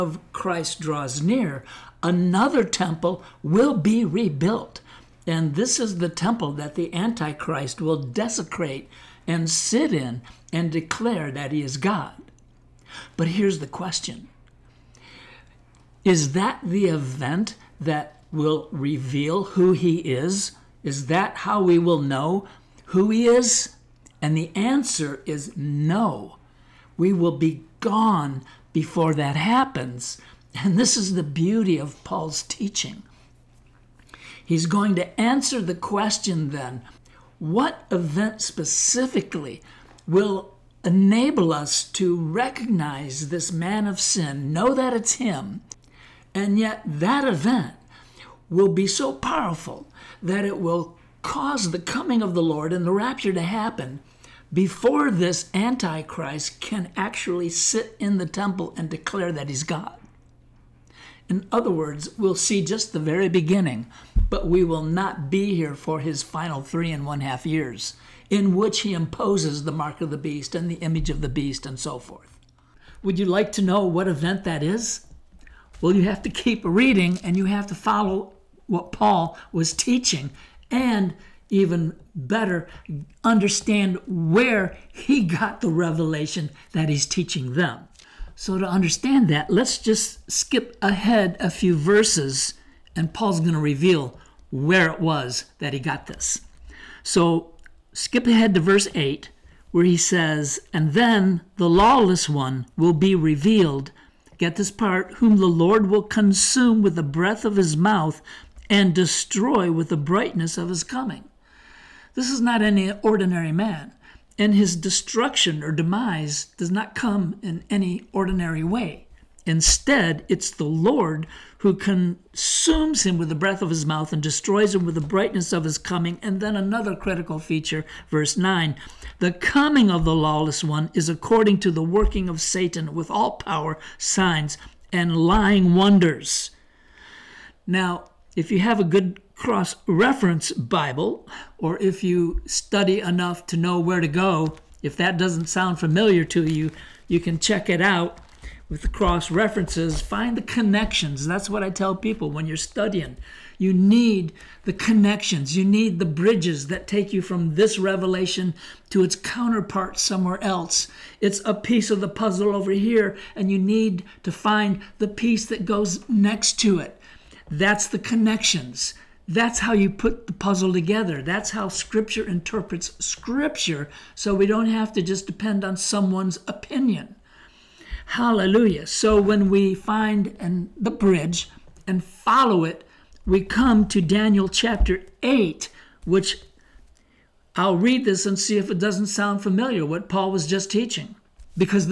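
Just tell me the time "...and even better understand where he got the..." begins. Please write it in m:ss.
1:20.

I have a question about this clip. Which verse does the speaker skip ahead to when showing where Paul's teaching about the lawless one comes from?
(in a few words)
verse 8.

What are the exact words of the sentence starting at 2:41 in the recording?
It's a piece of the puzzle over here, and you need to find the piece that goes next to it.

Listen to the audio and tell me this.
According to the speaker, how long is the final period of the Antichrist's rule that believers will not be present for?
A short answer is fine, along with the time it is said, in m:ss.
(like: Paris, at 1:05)
3.5 years, at 1:06.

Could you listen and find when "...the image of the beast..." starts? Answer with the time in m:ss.
1:10.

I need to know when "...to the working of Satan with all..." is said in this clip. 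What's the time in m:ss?
2:11.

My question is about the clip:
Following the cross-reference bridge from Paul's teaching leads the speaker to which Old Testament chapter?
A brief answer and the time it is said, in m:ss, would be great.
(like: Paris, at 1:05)
Daniel chapter 8, at 3:03.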